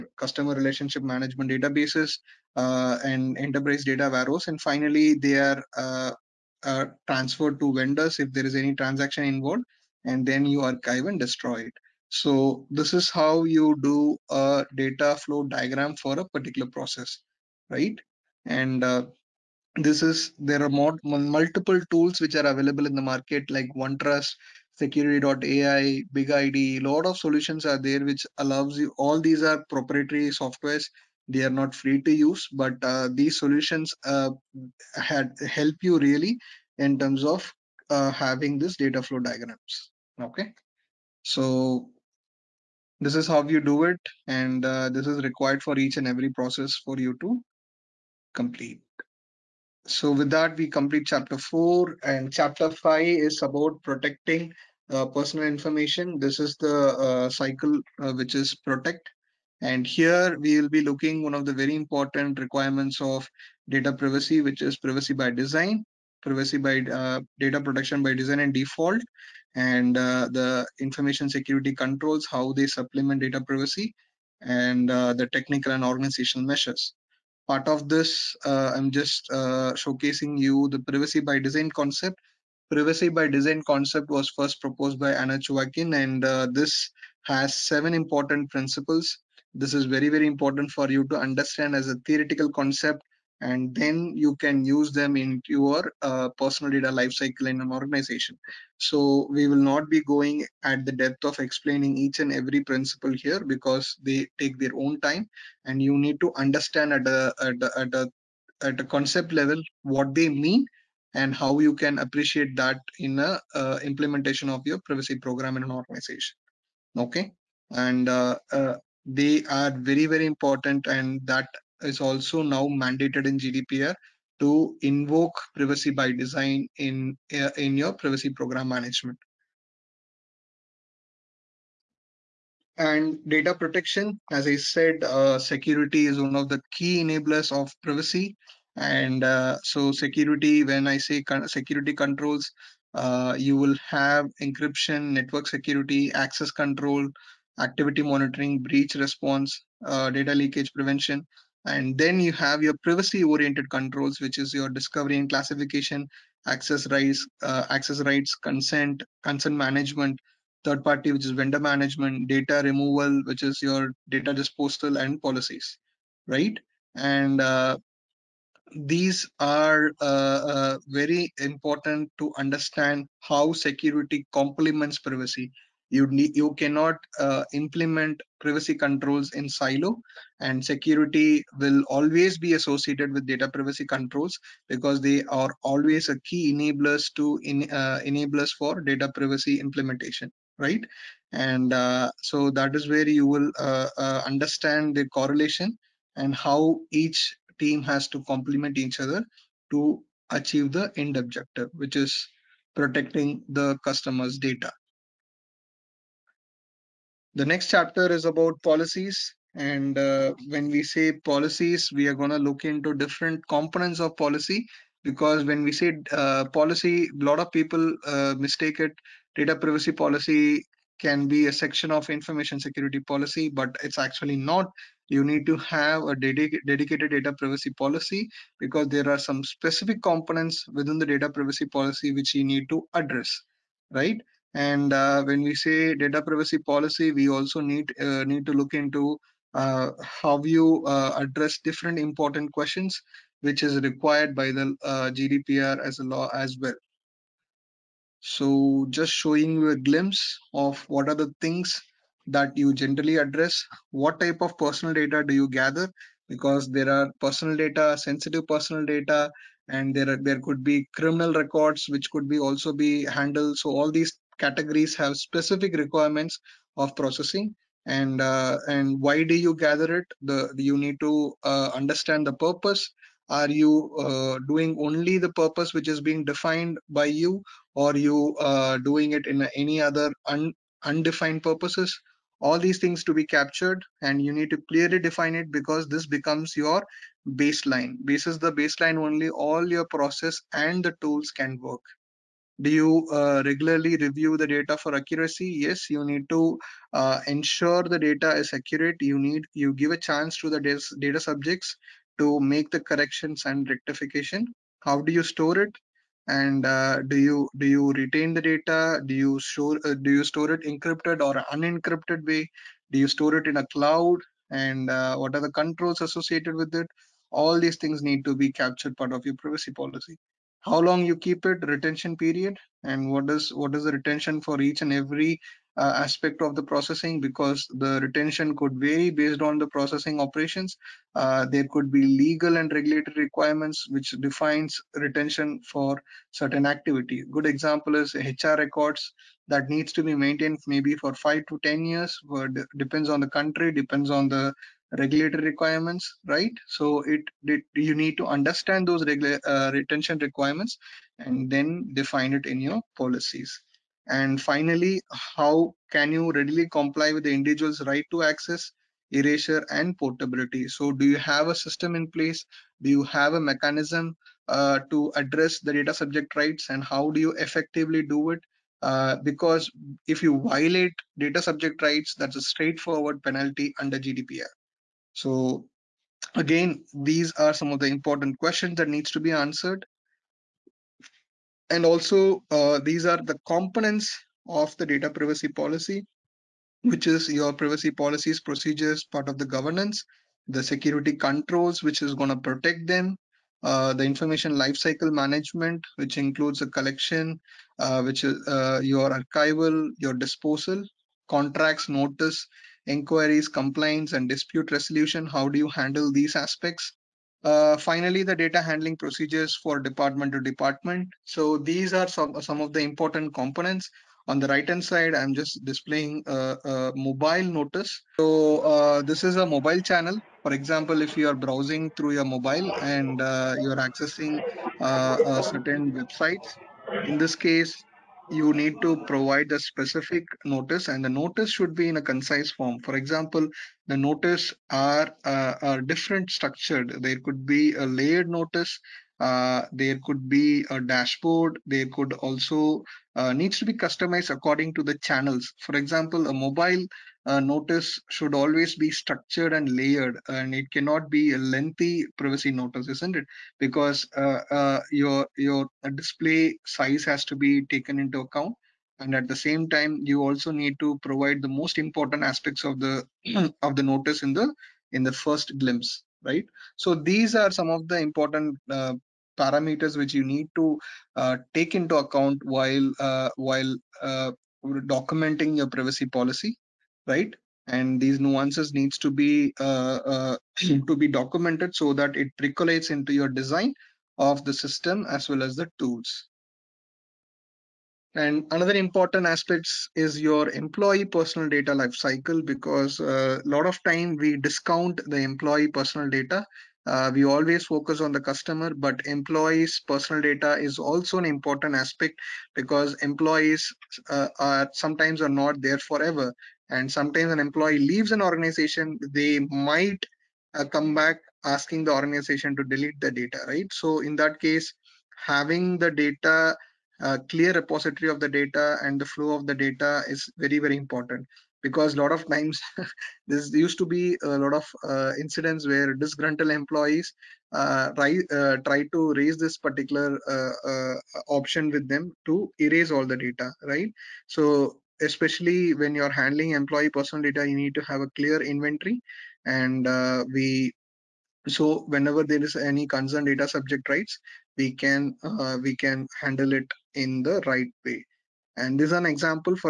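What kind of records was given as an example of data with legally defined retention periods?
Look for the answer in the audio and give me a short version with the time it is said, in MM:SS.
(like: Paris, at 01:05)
HR records, at 05:38.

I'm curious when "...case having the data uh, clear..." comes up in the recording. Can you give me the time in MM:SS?
08:34.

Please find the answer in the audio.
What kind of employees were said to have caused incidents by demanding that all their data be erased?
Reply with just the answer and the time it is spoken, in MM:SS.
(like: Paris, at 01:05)
disgruntled employees, at 08:45.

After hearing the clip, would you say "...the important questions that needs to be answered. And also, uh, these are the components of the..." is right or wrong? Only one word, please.
right.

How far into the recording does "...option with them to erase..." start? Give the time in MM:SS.
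08:51.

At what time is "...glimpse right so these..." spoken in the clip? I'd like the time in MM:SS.
07:45.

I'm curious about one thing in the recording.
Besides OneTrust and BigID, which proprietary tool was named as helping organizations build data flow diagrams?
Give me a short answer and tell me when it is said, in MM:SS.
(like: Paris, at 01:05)
Securiti.ai, at 00:24.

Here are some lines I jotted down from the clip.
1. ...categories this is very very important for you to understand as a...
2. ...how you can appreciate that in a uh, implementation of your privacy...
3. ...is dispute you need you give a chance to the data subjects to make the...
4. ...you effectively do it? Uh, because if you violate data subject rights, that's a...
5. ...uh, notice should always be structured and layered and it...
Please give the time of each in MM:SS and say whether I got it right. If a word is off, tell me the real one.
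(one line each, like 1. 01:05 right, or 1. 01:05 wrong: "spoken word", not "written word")
1. 01:28 wrong: "principles", not "categories"
2. 01:51 right
3. 04:58 wrong: "accurate", not "dispute"
4. 06:07 right
5. 07:27 right.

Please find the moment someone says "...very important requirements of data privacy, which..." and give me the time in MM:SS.
01:01.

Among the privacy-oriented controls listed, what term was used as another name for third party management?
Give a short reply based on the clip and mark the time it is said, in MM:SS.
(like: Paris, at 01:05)
vendor management, at 02:41.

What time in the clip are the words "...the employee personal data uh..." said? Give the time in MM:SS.
08:15.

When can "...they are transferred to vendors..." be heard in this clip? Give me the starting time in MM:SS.
00:05.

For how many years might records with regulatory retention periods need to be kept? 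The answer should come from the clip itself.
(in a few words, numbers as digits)
5 to 10 years.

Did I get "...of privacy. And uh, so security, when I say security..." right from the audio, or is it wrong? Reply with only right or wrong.
right.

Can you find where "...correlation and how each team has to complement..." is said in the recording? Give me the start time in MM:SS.
03:15.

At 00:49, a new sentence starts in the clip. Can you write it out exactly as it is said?
So with that, we complete chapter four and chapter five is about protecting uh, personal information.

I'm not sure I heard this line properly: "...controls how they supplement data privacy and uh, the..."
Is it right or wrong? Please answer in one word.
right.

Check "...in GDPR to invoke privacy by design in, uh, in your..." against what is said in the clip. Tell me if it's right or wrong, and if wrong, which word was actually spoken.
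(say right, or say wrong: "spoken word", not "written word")
right.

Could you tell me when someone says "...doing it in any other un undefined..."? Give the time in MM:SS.
04:38.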